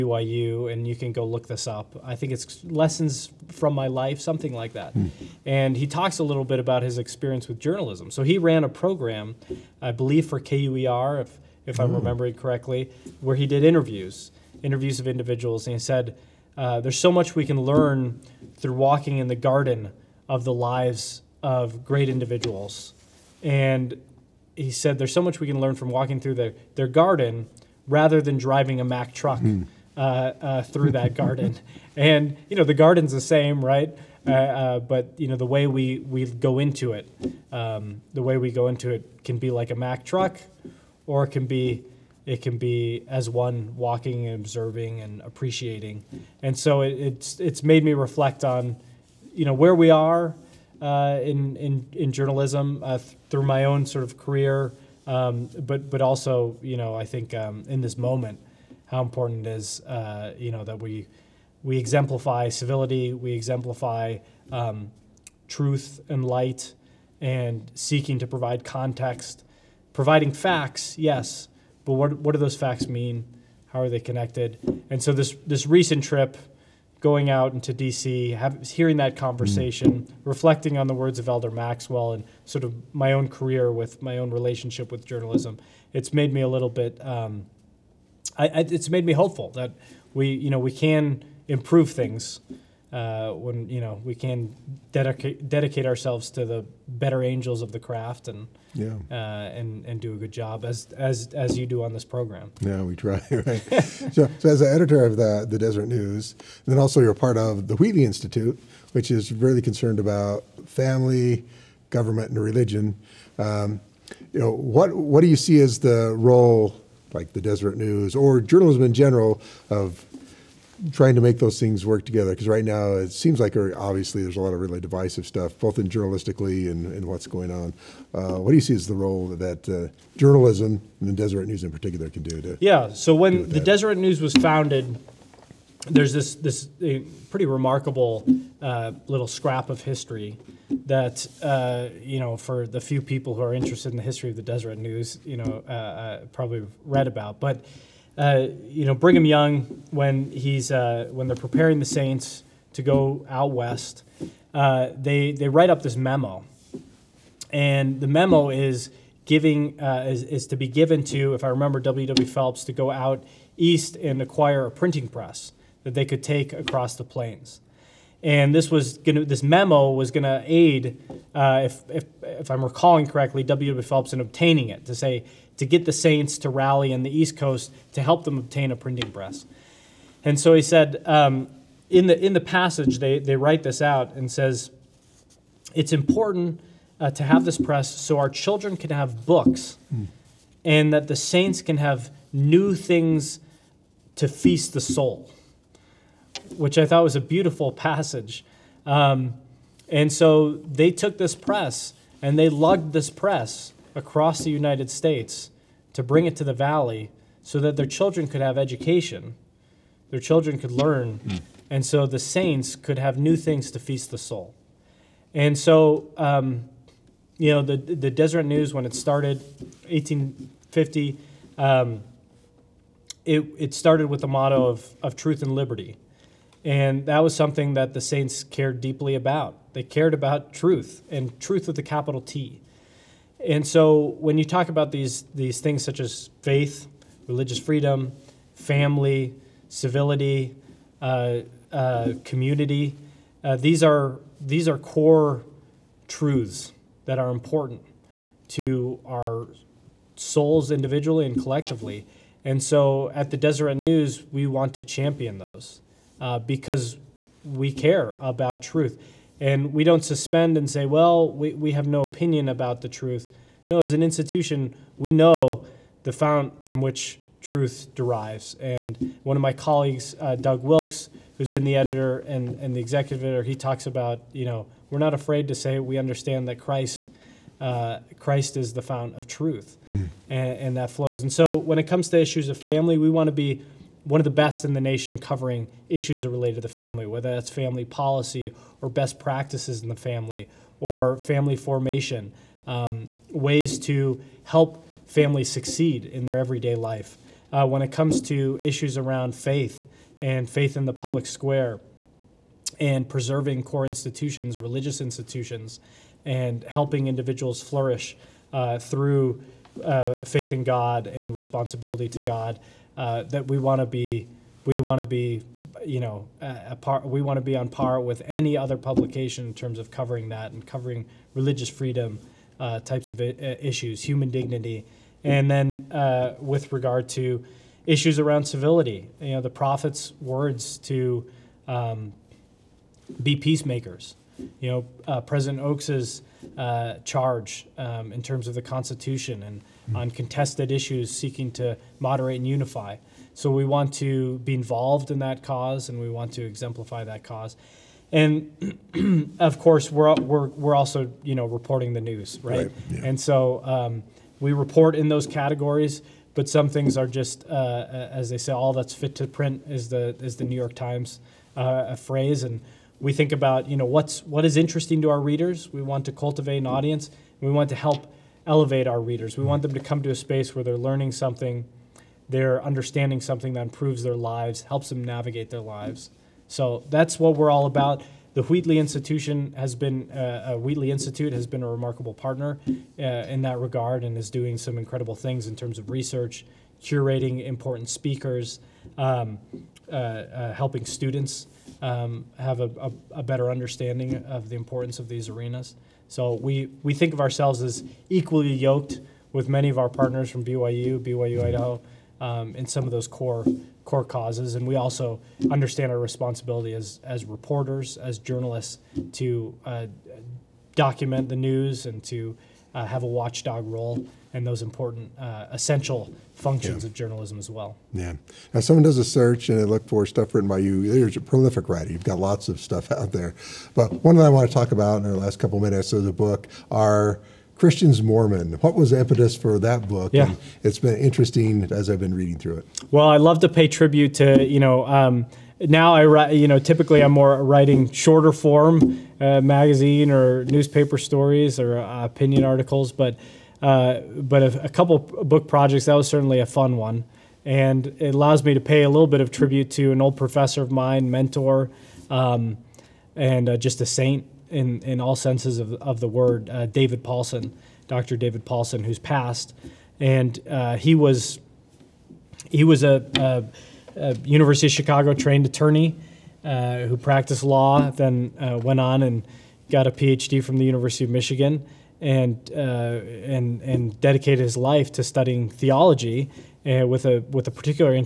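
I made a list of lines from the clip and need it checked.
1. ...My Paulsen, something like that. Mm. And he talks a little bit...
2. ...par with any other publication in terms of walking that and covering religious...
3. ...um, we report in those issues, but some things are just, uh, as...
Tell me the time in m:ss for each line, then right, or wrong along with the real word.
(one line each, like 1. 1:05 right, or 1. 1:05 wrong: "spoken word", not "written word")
1. 0:03 wrong: "Life", not "Paulsen"
2. 5:17 wrong: "covering", not "walking"
3. 5:53 wrong: "categories", not "issues".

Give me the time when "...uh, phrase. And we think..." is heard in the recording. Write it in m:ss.
6:01.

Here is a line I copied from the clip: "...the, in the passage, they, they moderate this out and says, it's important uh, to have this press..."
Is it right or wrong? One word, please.
wrong.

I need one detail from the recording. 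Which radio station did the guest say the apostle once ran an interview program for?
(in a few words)
KUER.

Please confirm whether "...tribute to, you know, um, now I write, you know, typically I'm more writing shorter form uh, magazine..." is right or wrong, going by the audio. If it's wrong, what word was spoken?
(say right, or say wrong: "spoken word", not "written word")
right.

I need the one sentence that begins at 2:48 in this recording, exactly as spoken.
And this was gonna, this memo was going to aid, uh, if, if, if I'm recalling correctly, W.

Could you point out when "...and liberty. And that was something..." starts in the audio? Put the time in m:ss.
3:45.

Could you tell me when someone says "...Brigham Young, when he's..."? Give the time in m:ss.
2:28.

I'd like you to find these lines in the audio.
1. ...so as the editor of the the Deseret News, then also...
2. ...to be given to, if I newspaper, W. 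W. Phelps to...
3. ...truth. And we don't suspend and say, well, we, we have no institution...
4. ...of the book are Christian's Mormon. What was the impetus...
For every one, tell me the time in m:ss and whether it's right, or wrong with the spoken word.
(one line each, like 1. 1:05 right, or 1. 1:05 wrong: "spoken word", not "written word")
1. 1:44 right
2. 2:40 wrong: "remember", not "newspaper"
3. 4:18 wrong: "opinion", not "institution"
4. 7:05 right.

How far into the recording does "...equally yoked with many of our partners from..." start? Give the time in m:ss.
6:38.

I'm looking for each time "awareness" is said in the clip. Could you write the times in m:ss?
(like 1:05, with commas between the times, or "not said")
not said.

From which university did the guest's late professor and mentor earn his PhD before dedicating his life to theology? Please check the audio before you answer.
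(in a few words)
University of Michigan.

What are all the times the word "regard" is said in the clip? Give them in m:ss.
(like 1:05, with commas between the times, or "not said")
5:26, 6:23.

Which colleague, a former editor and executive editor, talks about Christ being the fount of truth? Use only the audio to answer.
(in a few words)
Doug Wilks.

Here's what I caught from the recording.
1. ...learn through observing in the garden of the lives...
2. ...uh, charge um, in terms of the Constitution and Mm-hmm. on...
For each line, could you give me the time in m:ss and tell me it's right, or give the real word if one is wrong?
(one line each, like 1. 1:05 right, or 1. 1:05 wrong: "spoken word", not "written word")
1. 0:17 wrong: "walking", not "observing"
2. 5:36 right.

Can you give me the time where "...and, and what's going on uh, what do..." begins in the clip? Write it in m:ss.
2:06.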